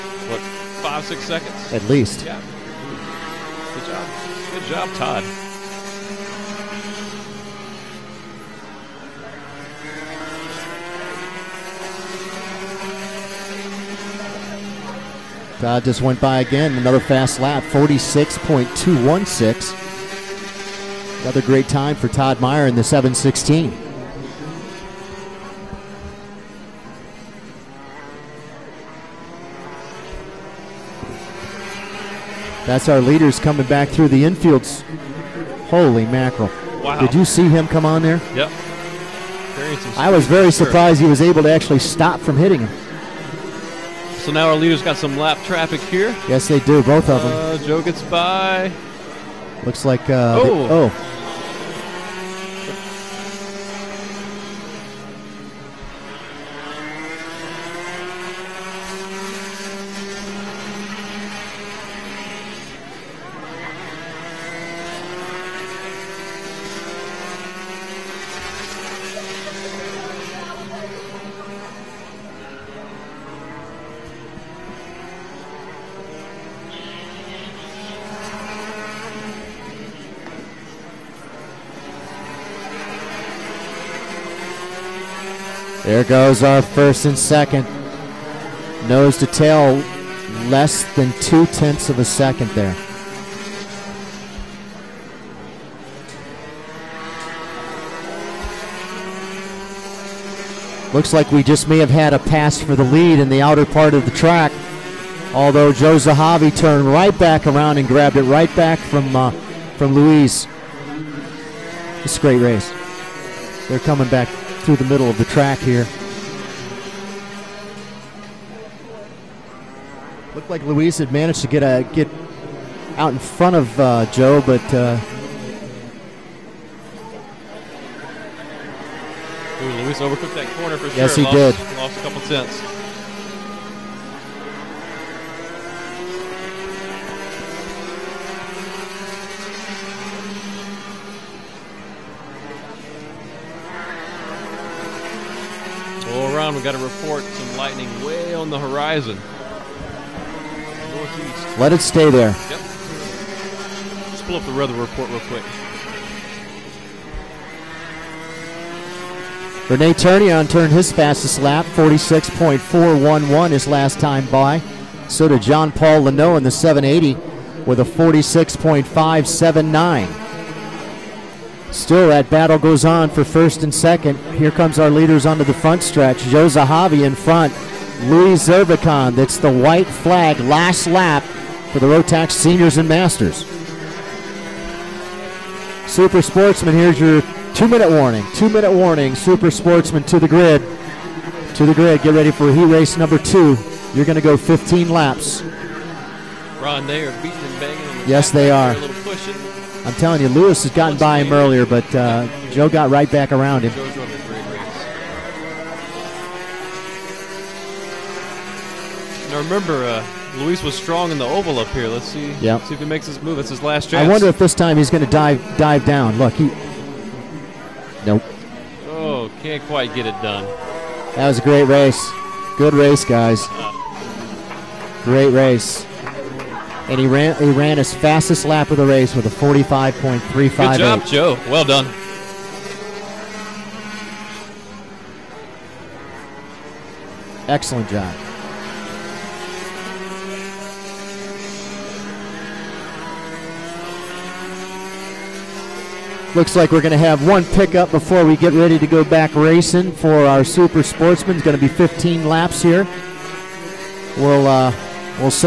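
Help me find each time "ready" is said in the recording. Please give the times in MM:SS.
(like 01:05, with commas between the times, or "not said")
03:12, 04:08.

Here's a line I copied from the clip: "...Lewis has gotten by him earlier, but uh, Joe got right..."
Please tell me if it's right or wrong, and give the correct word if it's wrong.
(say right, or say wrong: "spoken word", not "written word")
right.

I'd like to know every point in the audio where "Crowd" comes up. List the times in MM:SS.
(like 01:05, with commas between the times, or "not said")
00:15.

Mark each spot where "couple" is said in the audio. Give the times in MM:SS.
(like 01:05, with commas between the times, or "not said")
02:12.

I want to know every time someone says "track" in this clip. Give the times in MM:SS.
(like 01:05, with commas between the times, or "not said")
01:44, 01:55.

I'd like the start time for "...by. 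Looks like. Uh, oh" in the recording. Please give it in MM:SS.
00:48.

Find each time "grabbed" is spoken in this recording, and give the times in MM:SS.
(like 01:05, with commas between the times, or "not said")
01:47.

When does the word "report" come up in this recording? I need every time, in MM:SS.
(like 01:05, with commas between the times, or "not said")
02:26, 02:34.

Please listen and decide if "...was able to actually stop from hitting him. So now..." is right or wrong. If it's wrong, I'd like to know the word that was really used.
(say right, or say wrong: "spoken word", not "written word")
right.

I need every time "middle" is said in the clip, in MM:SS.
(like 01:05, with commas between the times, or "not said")
01:54.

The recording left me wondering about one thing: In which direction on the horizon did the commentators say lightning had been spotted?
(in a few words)
Northeast.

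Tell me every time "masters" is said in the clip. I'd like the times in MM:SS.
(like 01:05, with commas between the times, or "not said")
03:02.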